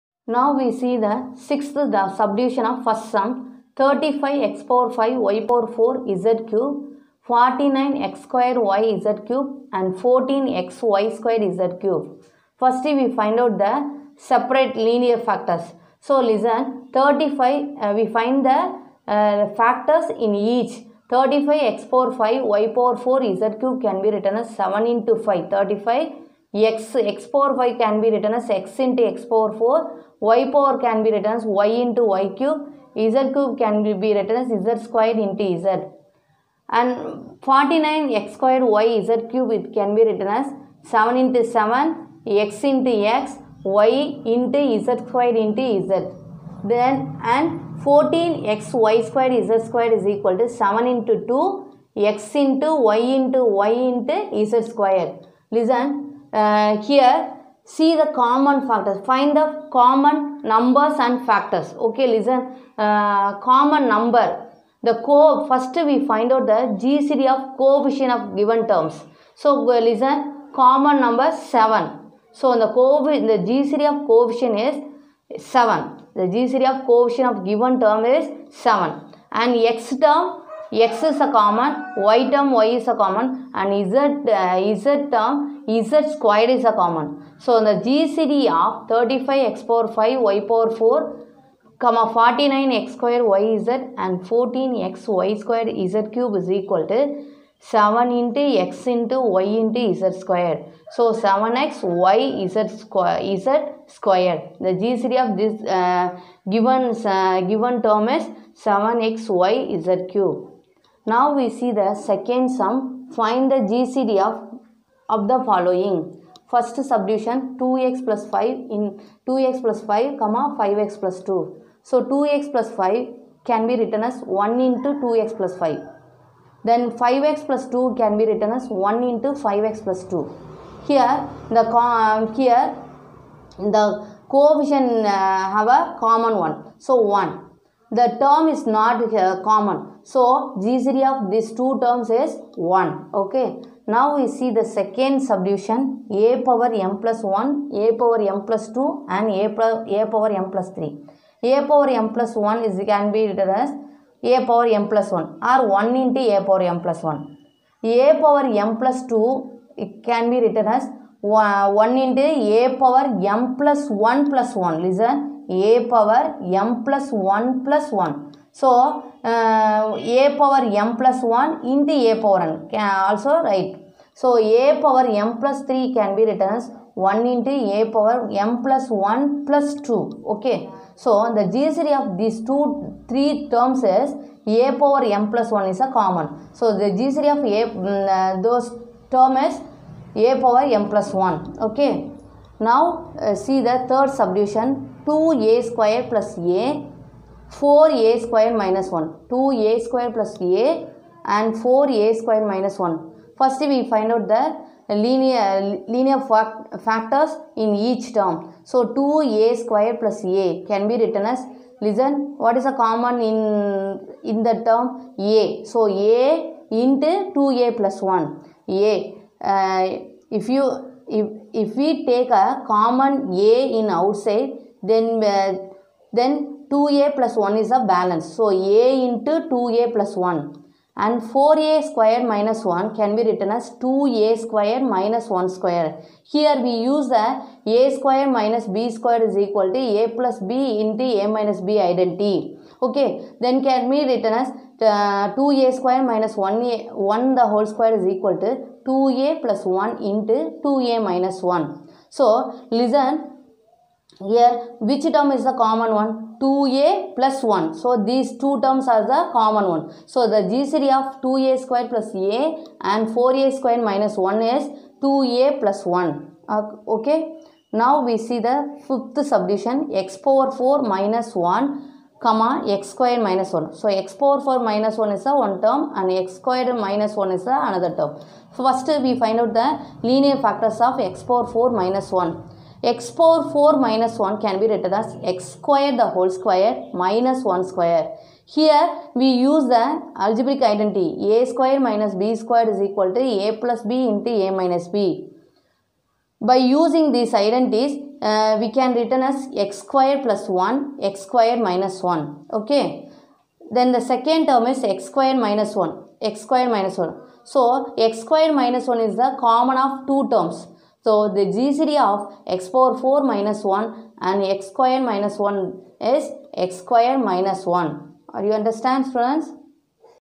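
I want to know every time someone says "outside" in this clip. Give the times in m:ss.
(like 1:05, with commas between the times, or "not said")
3:43.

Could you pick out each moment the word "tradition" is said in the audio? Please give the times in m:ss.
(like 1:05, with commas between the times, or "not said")
not said.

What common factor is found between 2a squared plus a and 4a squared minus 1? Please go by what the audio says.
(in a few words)
2a plus 1.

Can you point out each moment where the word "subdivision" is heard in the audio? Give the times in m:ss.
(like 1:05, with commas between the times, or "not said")
0:02, 2:25, 3:14, 4:29.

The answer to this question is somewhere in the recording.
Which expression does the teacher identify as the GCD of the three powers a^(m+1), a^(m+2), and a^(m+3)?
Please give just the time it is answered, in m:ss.
3:06.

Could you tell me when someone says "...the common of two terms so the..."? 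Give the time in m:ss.
5:09.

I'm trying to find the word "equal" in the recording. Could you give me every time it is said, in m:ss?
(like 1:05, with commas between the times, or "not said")
0:50, 1:36, 3:59, 4:08, 4:52.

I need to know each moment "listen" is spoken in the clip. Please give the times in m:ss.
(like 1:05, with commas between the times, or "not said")
0:16, 0:55, 1:02, 1:09, 2:44, 3:31, 4:12.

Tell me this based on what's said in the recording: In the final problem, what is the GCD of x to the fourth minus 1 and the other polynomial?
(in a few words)
x square minus 1.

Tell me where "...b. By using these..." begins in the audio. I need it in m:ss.
4:54.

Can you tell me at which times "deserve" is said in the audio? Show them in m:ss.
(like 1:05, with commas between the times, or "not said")
not said.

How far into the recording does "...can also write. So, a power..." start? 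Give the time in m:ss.
2:52.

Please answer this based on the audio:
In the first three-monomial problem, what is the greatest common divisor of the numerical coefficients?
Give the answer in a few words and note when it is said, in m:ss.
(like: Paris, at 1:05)
7, at 1:13.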